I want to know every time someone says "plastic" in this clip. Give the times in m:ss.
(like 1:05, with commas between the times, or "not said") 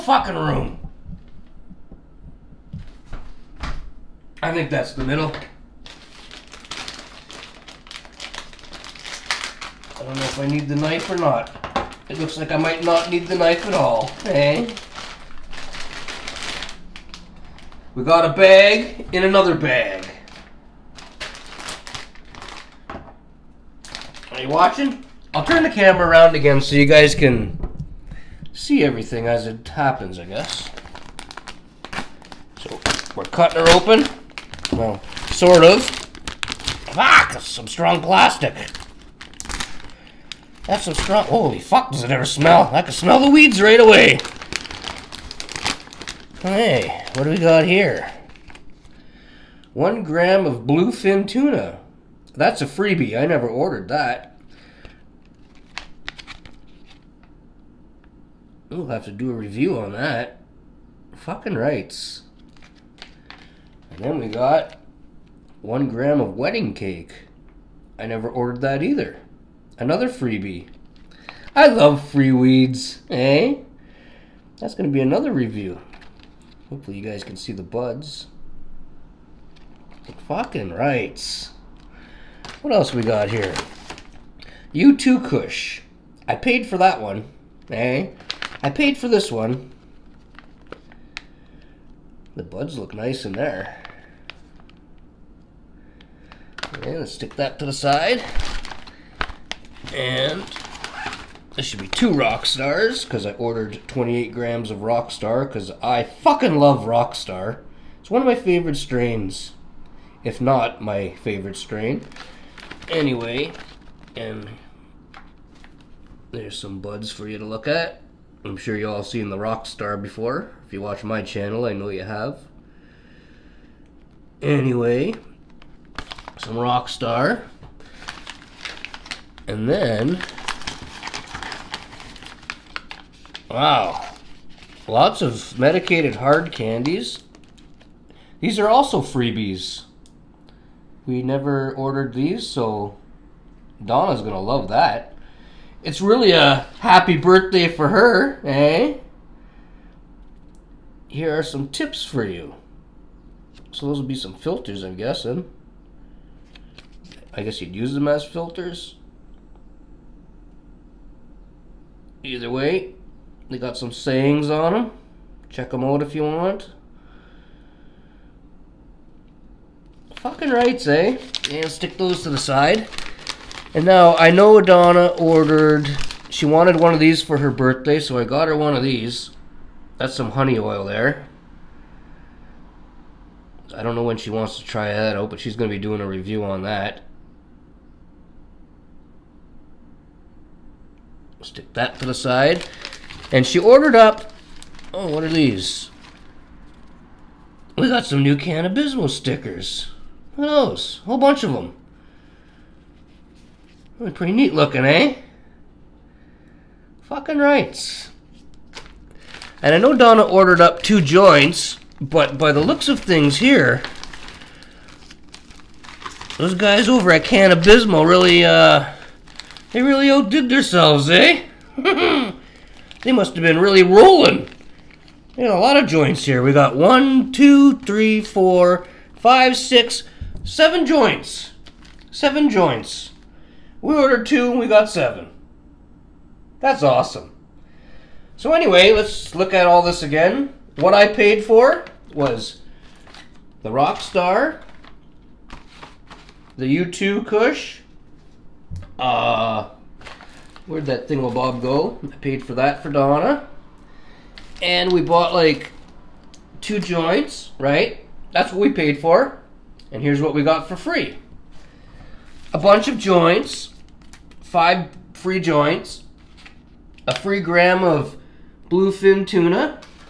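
0:38.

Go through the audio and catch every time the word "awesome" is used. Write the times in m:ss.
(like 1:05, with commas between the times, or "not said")
3:56.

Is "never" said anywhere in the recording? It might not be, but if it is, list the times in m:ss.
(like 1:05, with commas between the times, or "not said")
0:53, 1:08, 2:21.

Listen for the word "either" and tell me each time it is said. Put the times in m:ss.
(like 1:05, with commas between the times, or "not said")
1:08, 2:42.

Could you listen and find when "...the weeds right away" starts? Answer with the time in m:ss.
0:43.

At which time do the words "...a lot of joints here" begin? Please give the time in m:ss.
3:45.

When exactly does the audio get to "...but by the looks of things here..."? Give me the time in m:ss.
3:32.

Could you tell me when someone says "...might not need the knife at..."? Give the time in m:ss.
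0:12.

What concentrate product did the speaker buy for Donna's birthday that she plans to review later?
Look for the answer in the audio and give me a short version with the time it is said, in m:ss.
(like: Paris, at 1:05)
Honey oil, at 3:00.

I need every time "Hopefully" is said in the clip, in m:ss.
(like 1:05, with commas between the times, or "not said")
1:16.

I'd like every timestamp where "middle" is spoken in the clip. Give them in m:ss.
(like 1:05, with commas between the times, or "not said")
0:05.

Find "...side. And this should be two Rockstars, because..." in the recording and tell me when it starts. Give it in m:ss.
1:37.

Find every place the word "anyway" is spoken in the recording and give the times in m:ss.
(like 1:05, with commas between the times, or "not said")
1:52, 2:04, 3:58.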